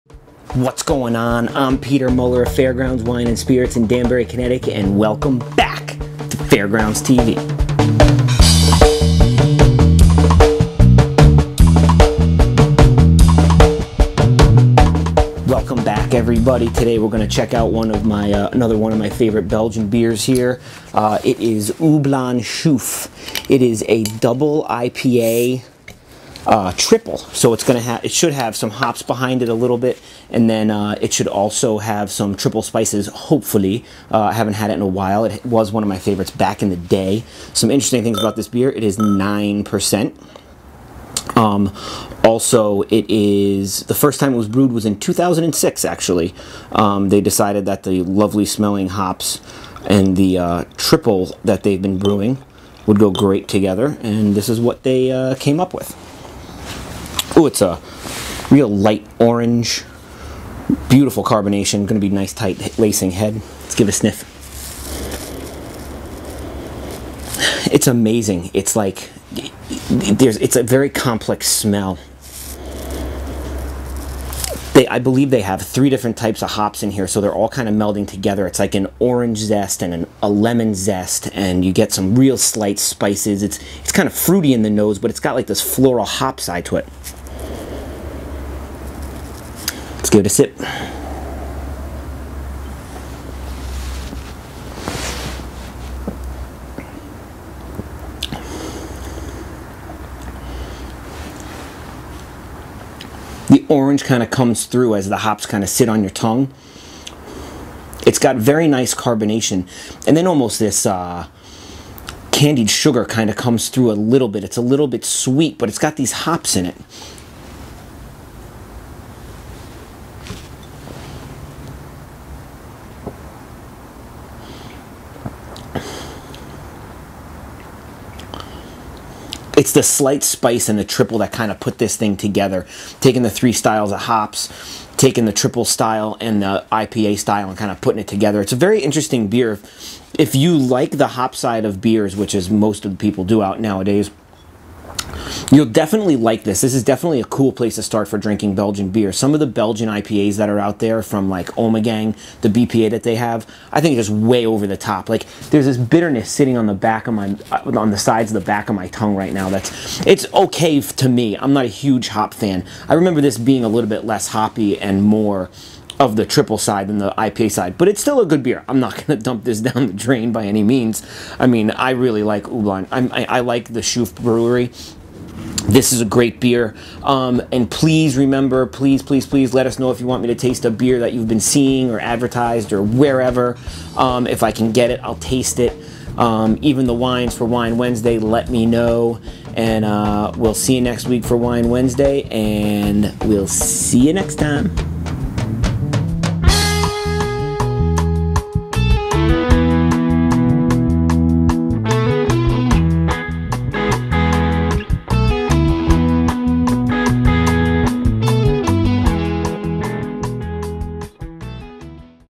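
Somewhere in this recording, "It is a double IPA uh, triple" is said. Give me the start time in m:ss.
0:23.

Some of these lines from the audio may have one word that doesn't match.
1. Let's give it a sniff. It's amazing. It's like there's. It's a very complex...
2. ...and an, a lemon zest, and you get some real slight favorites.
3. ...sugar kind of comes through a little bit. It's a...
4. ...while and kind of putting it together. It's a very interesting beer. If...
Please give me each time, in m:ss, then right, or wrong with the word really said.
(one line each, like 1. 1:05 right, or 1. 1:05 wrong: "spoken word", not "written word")
1. 1:03 right
2. 1:19 wrong: "spices", not "favorites"
3. 1:52 right
4. 2:17 wrong: "style", not "while".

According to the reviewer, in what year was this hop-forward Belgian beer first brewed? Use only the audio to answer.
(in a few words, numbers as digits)
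2006.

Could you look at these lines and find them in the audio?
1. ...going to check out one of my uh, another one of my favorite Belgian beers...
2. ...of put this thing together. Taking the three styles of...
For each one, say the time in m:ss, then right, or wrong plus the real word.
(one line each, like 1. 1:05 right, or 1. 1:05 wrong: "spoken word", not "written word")
1. 0:17 right
2. 2:11 right.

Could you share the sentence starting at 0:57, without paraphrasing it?
Oh, it's a real light orange.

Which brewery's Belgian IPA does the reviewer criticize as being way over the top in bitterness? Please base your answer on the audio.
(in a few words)
Ommegang.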